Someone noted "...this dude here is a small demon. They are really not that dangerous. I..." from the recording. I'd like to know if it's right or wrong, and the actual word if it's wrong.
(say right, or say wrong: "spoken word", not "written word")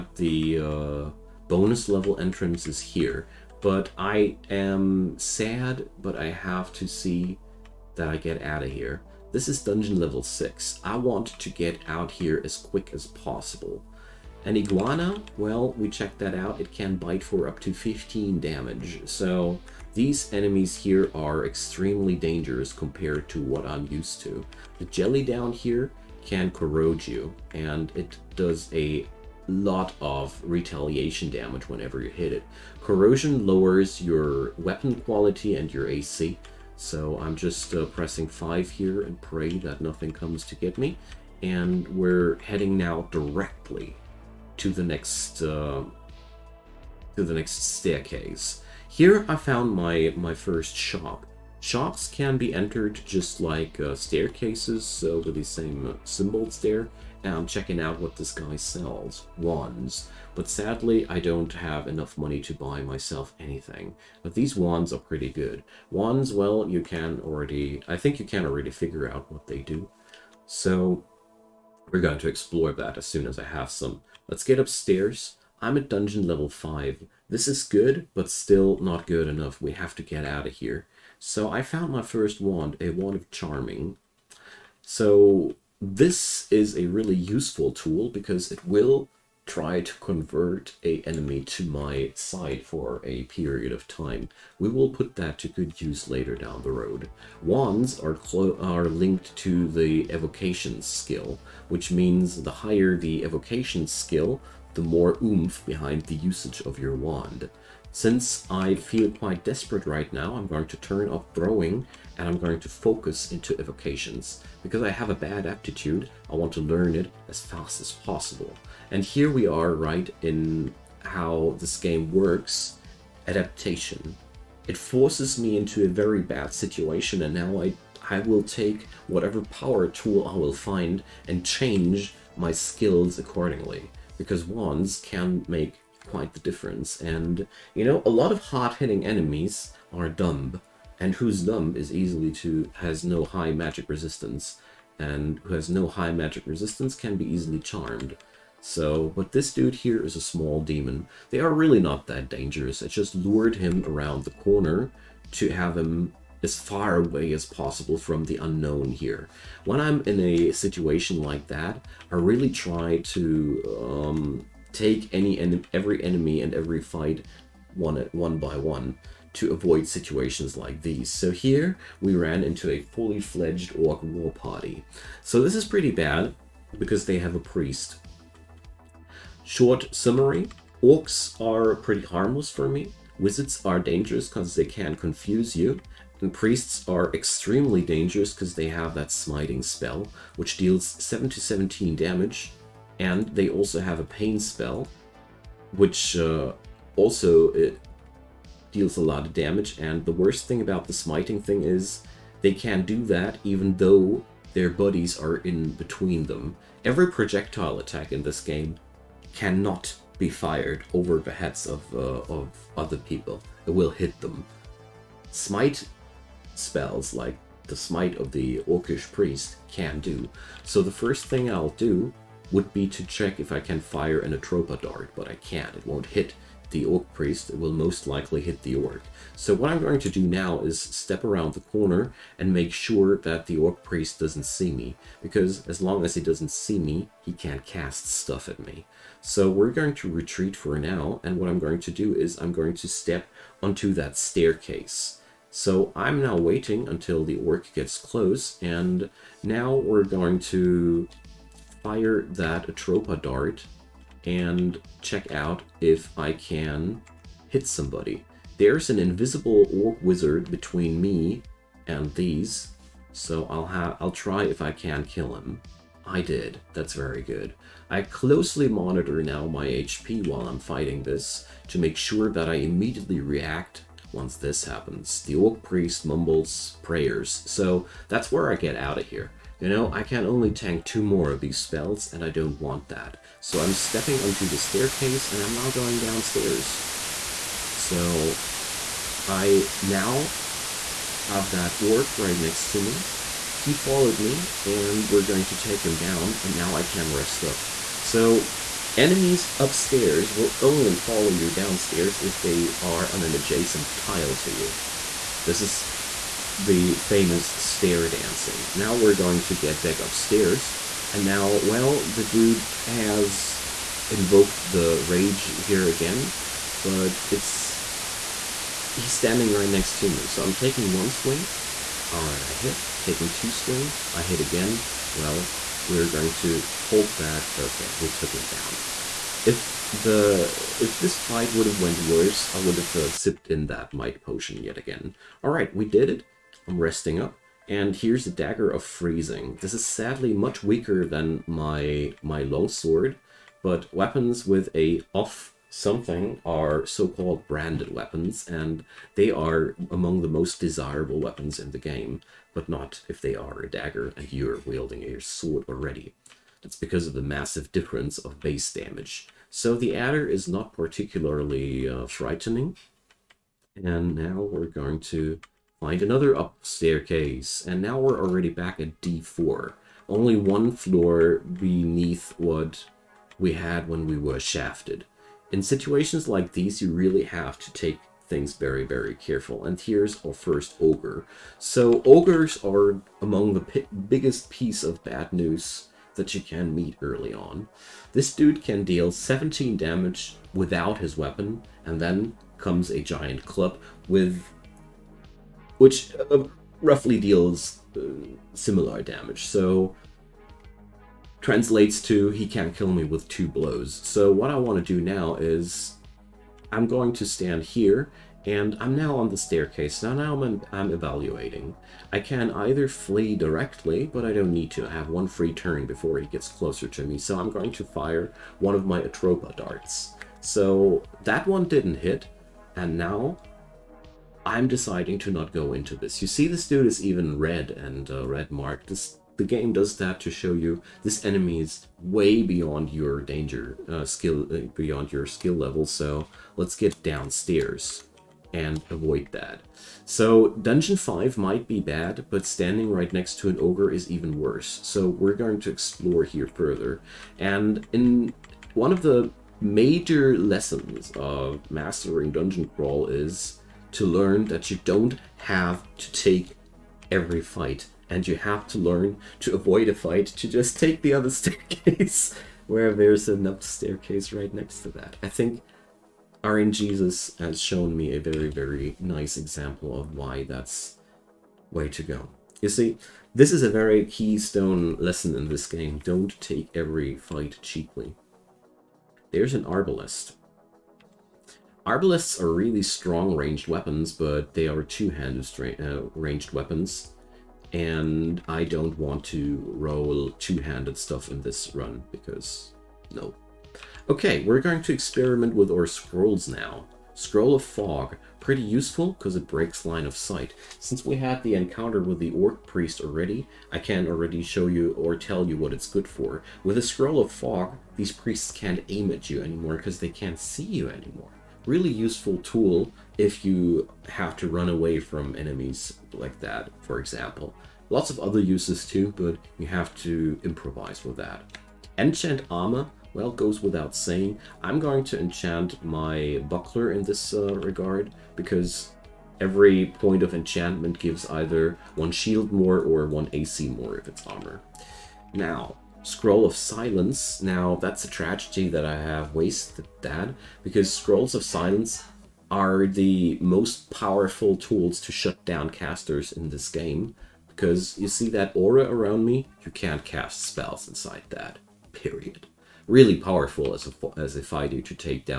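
right.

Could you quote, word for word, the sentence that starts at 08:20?
Since we had the encounter with the Orc Priest already, I can already show you or tell you what it's good for.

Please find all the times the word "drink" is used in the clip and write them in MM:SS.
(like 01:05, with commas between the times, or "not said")
not said.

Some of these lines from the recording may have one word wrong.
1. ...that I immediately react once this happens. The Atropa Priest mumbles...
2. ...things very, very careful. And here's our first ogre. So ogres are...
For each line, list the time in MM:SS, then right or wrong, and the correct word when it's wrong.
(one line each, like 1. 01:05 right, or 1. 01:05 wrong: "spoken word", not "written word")
1. 04:32 wrong: "Orc", not "Atropa"
2. 06:18 right.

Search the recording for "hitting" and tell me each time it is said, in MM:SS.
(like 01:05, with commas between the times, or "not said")
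02:18.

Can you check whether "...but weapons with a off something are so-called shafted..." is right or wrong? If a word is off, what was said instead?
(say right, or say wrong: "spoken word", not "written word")
wrong: "branded", not "shafted".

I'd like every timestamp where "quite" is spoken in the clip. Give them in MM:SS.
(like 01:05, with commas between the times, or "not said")
01:49, 02:16.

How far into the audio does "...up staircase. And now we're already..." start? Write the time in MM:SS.
06:06.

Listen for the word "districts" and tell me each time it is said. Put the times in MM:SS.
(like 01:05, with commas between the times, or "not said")
not said.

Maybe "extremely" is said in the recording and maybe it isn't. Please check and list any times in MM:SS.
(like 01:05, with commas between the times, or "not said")
00:21, 03:07.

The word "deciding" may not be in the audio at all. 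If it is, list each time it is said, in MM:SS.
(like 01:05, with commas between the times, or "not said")
07:04.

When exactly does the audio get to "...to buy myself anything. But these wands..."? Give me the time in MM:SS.
01:02.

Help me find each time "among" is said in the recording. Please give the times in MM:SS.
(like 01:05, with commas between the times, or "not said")
05:49, 06:23.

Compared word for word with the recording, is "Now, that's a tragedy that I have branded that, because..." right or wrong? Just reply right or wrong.
wrong.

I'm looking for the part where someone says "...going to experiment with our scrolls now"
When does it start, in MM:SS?
08:14.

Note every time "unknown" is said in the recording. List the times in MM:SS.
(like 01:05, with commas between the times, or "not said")
02:38.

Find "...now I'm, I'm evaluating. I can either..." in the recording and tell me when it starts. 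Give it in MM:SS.
06:50.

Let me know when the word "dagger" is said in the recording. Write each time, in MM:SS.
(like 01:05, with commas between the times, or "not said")
05:38, 05:53.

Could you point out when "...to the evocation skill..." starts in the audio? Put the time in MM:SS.
01:39.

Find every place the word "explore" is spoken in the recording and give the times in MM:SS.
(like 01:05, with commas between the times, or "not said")
01:12, 07:25.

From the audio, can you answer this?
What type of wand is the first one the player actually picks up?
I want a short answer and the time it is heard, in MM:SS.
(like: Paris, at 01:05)
Wand of charming, at 01:22.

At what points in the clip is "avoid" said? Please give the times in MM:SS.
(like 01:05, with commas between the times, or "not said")
02:49, 07:18, 07:39.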